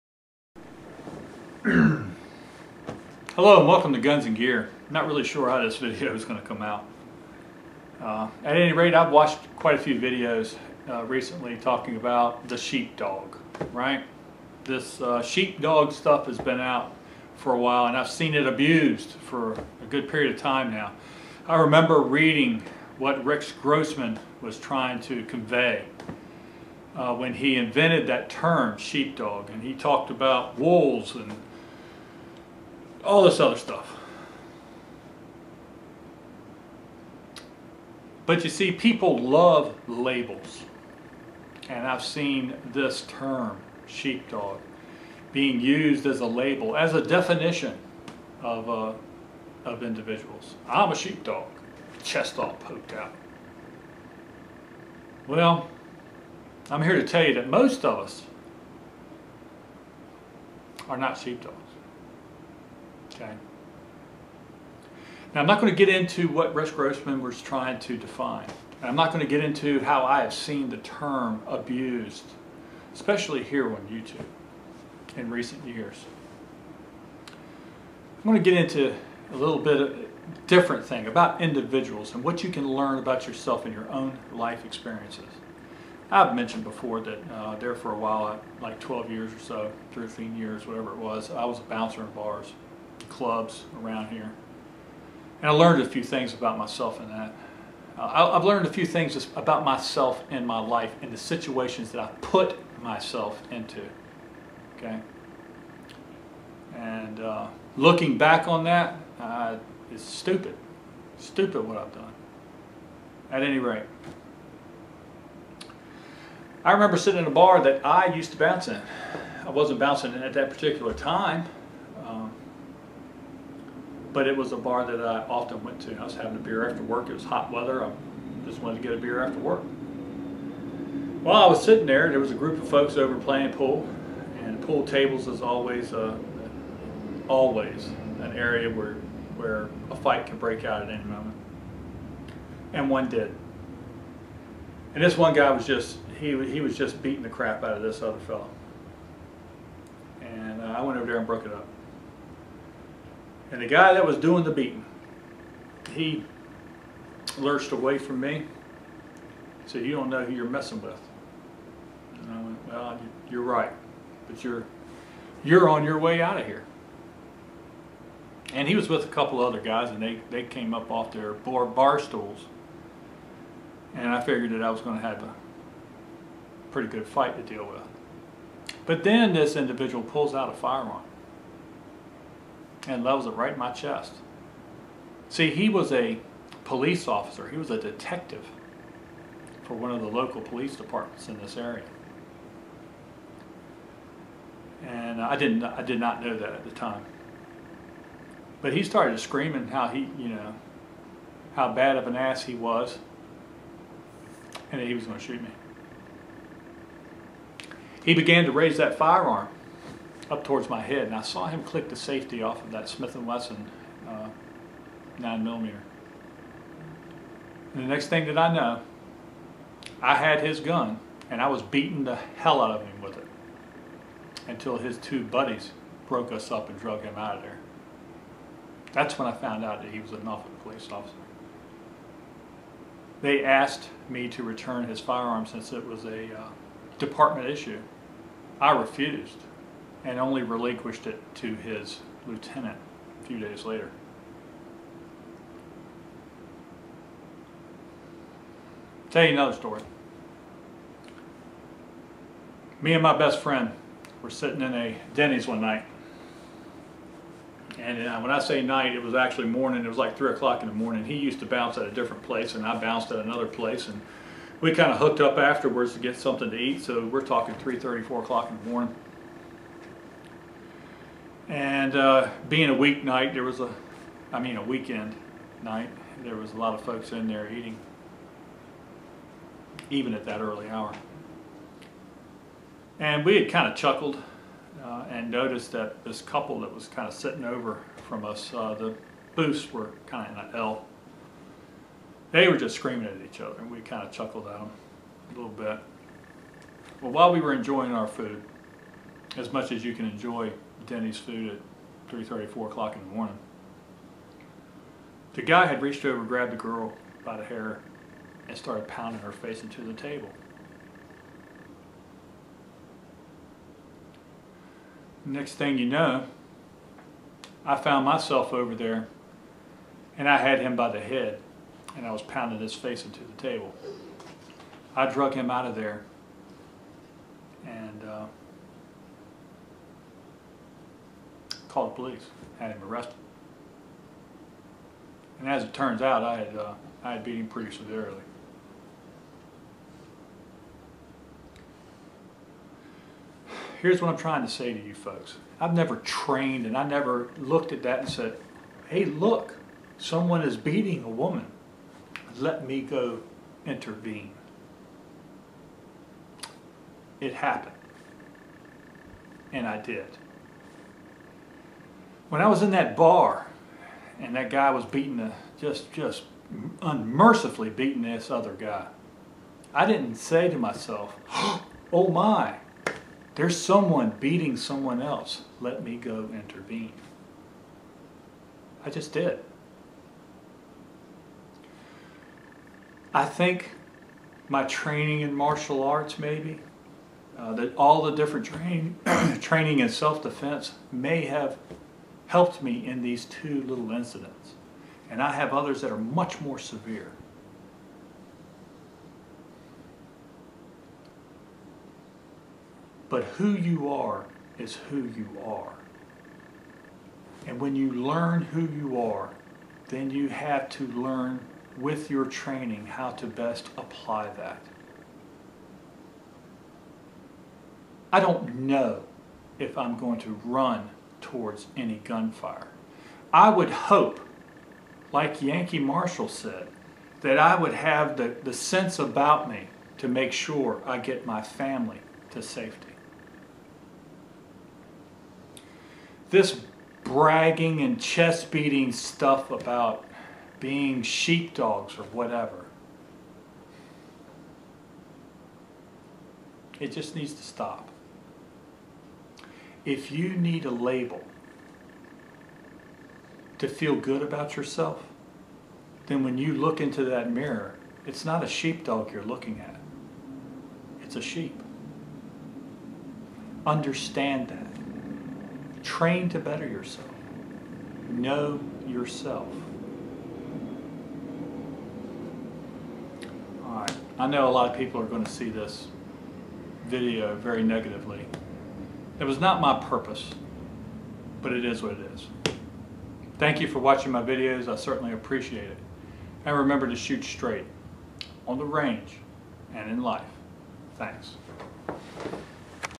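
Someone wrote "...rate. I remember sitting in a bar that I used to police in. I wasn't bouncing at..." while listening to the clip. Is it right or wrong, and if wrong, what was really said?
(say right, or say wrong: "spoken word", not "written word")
wrong: "bounce", not "police".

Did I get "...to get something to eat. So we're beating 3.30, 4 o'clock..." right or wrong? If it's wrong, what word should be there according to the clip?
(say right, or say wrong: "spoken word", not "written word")
wrong: "talking", not "beating".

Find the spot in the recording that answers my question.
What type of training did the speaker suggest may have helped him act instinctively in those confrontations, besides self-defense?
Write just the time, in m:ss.
6:25.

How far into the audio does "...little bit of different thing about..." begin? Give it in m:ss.
1:19.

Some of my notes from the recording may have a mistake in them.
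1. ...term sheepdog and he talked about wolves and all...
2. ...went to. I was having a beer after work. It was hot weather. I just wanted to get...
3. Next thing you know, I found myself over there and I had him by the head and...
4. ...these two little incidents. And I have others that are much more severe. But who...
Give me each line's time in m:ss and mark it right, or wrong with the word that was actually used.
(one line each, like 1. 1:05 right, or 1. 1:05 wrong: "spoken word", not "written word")
1. 0:28 right
2. 2:05 right
3. 5:15 right
4. 6:33 right.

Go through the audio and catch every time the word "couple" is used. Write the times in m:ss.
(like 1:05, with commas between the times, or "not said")
2:49, 4:46.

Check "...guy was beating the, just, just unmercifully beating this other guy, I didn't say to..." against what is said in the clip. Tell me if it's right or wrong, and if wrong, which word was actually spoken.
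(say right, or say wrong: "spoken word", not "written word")
right.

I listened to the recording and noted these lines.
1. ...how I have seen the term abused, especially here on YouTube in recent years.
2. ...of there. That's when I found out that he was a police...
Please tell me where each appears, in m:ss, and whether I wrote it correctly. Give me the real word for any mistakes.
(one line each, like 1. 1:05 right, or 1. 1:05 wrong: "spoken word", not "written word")
1. 1:09 right
2. 3:47 right.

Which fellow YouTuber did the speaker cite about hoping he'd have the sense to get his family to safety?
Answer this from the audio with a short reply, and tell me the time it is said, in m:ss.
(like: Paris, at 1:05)
Yankee Marshal, at 7:05.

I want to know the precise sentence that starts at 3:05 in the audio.
See, he was a police officer.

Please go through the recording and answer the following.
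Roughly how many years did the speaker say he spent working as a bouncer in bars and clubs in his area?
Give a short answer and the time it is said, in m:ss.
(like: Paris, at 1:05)
12, at 1:28.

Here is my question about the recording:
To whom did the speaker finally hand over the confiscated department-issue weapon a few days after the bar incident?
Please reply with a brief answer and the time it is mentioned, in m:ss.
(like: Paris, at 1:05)
His lieutenant, at 4:01.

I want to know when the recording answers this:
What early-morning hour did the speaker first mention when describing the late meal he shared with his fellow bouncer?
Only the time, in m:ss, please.
4:20.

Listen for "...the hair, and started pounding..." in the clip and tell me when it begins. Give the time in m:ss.
5:07.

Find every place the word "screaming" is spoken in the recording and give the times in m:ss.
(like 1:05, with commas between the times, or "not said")
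3:19, 4:52.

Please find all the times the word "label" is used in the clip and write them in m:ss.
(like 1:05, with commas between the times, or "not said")
0:39, 0:46, 7:30.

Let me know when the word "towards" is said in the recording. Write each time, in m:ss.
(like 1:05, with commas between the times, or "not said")
3:30, 7:01.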